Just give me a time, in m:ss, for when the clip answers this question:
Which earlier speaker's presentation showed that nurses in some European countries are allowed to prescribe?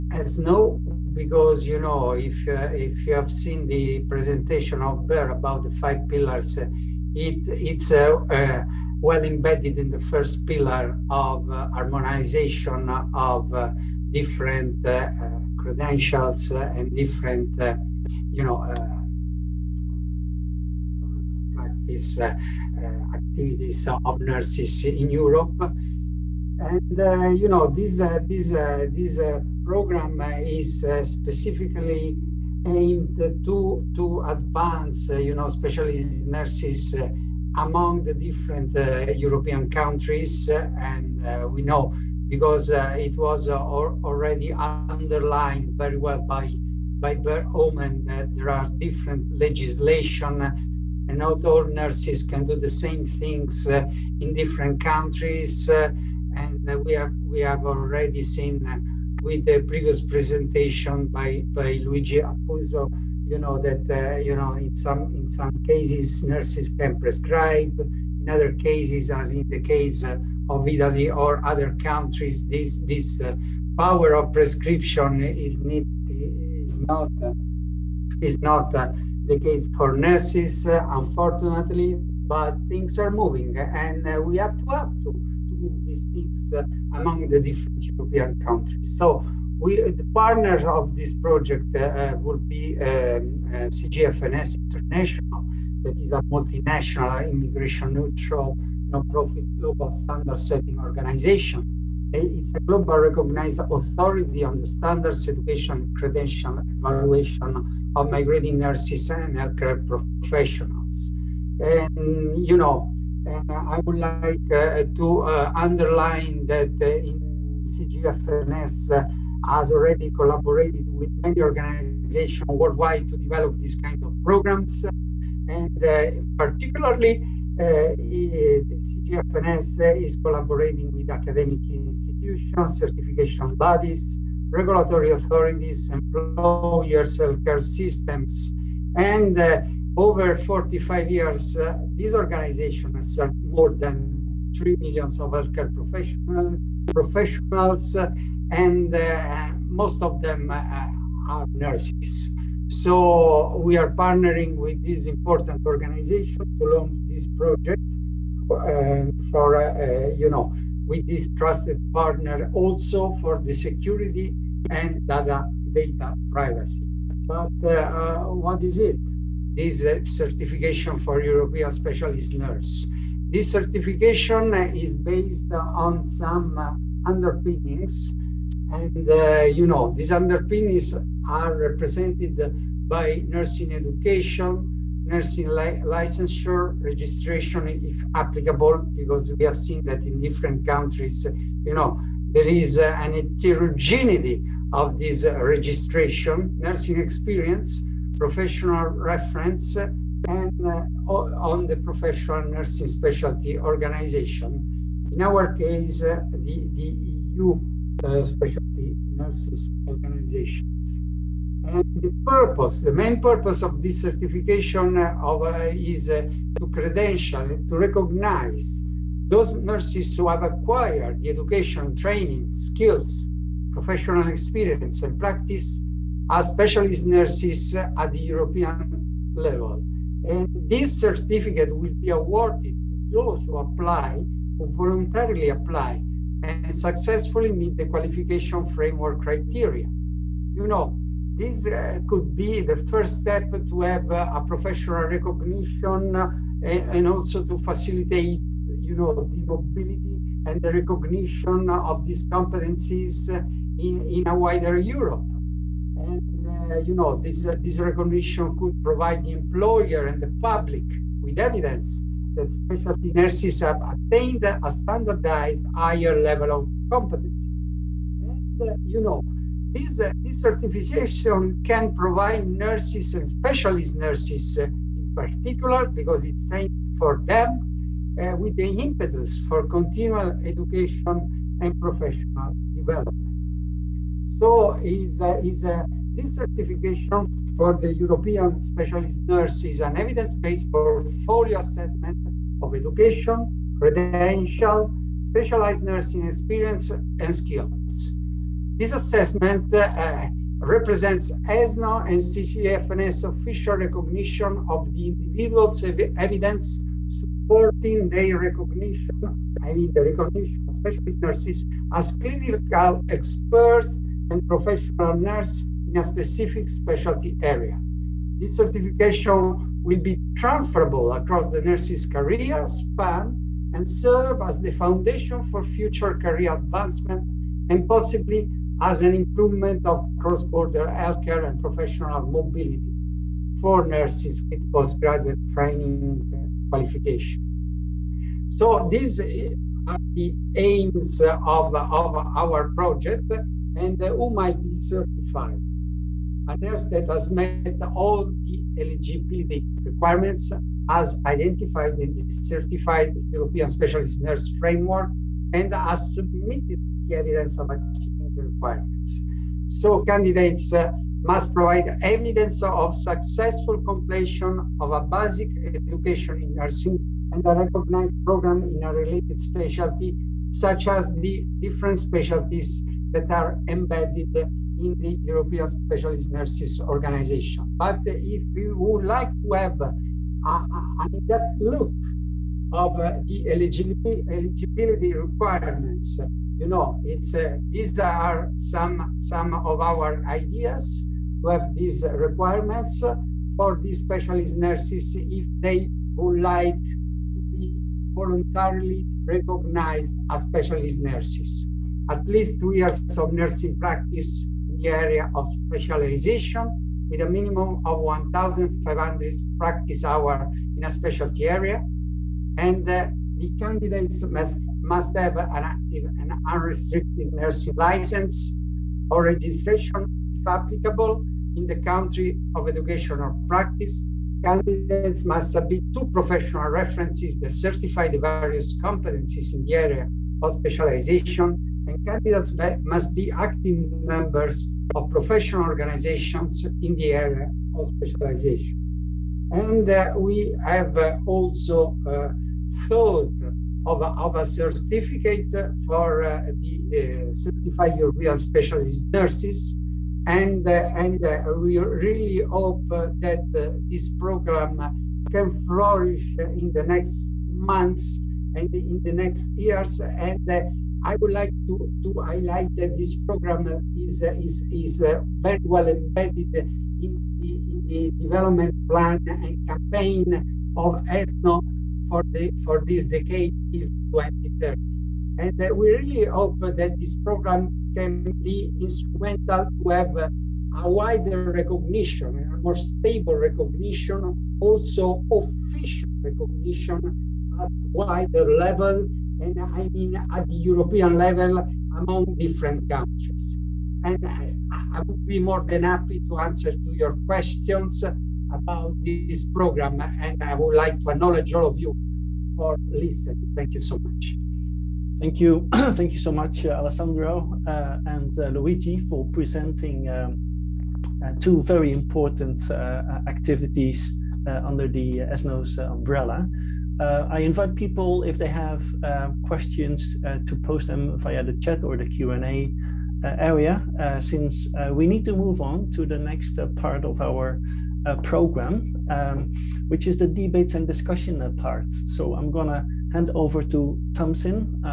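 1:01.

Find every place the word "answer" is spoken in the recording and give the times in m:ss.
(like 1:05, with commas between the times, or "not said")
8:16.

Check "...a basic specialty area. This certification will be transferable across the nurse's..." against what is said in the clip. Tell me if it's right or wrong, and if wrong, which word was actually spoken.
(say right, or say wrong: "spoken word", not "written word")
wrong: "specific", not "basic".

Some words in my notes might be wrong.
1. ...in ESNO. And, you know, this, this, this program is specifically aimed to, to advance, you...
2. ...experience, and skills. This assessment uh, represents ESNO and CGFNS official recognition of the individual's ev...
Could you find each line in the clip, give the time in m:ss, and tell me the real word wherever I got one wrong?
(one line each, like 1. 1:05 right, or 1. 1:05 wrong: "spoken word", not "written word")
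1. 0:24 wrong: "Europe", not "ESNO"
2. 4:56 right.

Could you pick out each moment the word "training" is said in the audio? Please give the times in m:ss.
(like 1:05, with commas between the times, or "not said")
3:41, 5:35.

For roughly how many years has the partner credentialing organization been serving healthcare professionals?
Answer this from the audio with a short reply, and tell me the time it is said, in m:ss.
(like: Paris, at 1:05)
over 45 years, at 2:19.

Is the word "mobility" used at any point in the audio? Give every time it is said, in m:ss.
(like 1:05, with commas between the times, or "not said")
4:09, 5:32.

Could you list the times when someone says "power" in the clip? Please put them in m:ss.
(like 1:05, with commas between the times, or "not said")
1:13.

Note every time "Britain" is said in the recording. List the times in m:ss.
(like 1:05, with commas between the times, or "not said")
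not said.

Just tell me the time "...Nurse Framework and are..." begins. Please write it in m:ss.
5:54.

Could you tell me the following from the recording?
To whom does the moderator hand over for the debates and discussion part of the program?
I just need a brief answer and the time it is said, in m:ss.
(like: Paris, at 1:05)
Tamsin, at 8:54.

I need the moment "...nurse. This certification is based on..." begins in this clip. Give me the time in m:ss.
2:52.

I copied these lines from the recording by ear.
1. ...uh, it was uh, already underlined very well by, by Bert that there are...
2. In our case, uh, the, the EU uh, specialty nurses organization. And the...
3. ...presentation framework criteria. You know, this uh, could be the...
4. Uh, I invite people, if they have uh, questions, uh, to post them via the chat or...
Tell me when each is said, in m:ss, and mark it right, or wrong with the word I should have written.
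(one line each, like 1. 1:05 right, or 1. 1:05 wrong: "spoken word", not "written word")
1. 0:42 right
2. 3:25 right
3. 3:57 wrong: "qualification", not "presentation"
4. 8:37 right.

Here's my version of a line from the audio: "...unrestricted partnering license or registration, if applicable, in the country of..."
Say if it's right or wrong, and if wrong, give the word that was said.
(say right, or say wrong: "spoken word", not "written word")
wrong: "nursing", not "partnering".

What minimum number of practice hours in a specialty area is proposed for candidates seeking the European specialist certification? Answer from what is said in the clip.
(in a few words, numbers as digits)
1,500.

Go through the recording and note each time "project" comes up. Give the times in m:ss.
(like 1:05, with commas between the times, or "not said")
1:31, 2:37, 5:42.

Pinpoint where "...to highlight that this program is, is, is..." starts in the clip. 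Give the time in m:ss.
7:42.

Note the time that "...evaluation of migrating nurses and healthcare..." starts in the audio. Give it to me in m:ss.
1:46.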